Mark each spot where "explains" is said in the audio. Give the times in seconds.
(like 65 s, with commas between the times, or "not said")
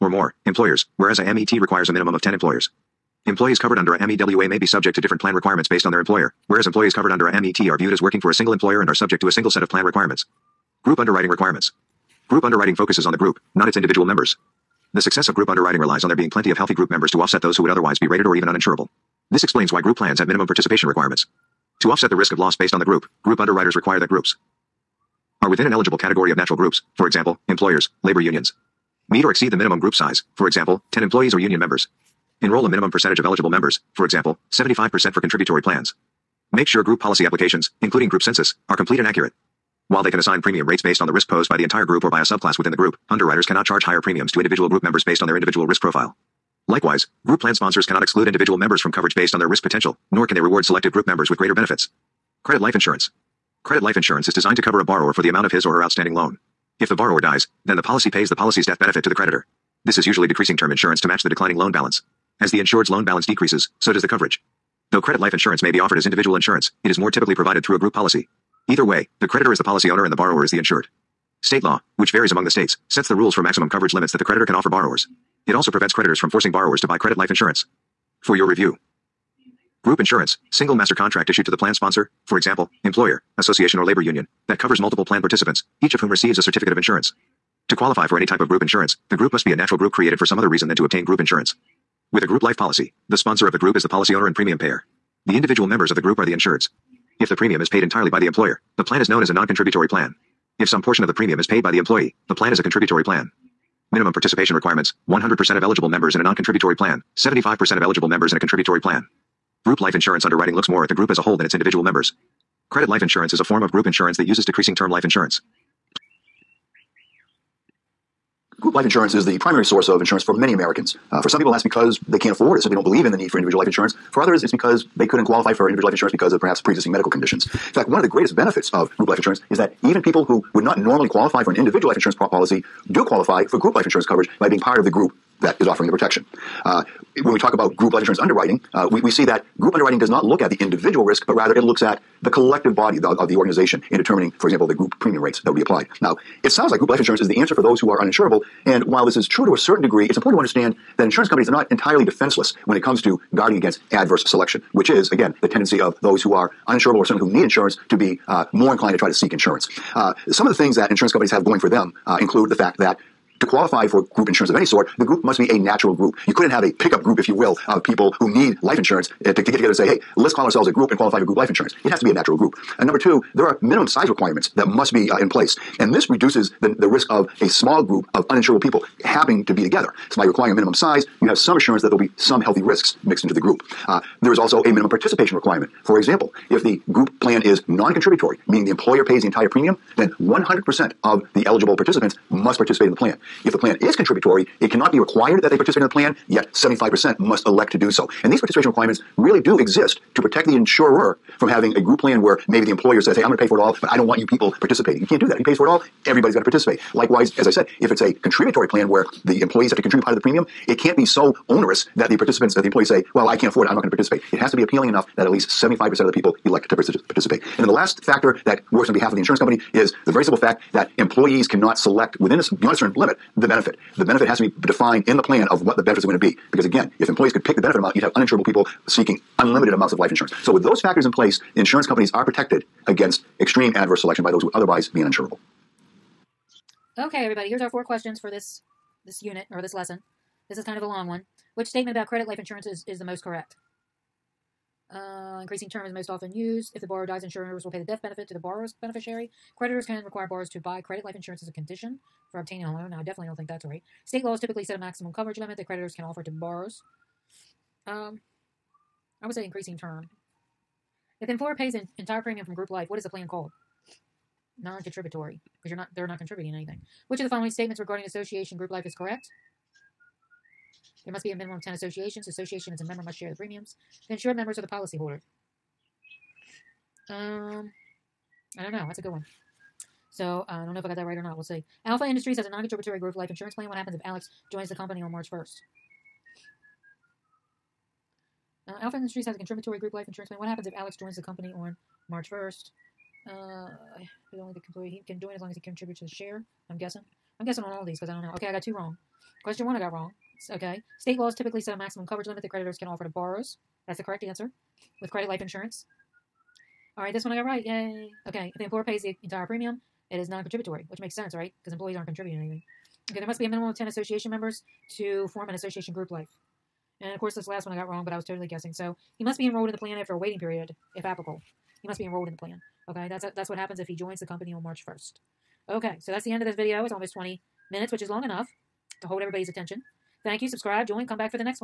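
19 s.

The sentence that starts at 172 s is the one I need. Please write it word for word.
And number two, there are minimum size requirements that must be uh, in place.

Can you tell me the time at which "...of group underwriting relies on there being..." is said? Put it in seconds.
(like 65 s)
15 s.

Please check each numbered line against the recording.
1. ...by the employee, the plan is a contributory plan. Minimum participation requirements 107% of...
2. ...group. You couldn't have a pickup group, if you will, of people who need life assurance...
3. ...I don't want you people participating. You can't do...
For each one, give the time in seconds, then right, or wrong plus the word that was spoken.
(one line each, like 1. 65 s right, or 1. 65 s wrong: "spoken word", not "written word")
1. 101 s wrong: "100", not "107"
2. 165 s wrong: "insurance", not "assurance"
3. 203 s right.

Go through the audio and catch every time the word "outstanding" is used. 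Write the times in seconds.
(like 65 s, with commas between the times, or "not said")
55 s.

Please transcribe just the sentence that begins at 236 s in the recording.
Okay, everybody, here's our four questions for this this unit or this lesson.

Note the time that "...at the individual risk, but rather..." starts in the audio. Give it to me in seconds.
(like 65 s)
140 s.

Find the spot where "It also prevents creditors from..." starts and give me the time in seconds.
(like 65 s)
75 s.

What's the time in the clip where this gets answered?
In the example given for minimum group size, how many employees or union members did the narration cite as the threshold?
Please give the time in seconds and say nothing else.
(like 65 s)
30 s.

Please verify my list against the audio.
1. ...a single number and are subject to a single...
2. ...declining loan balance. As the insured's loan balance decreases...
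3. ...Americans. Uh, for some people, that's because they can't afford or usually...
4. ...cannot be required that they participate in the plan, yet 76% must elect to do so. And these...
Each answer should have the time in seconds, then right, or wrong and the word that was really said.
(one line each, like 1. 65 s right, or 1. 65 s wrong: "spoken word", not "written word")
1. 8 s wrong: "employer", not "number"
2. 61 s right
3. 120 s wrong: "simply", not "usually"
4. 194 s wrong: "75", not "76".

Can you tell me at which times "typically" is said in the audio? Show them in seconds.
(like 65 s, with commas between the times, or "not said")
67 s, 254 s, 301 s.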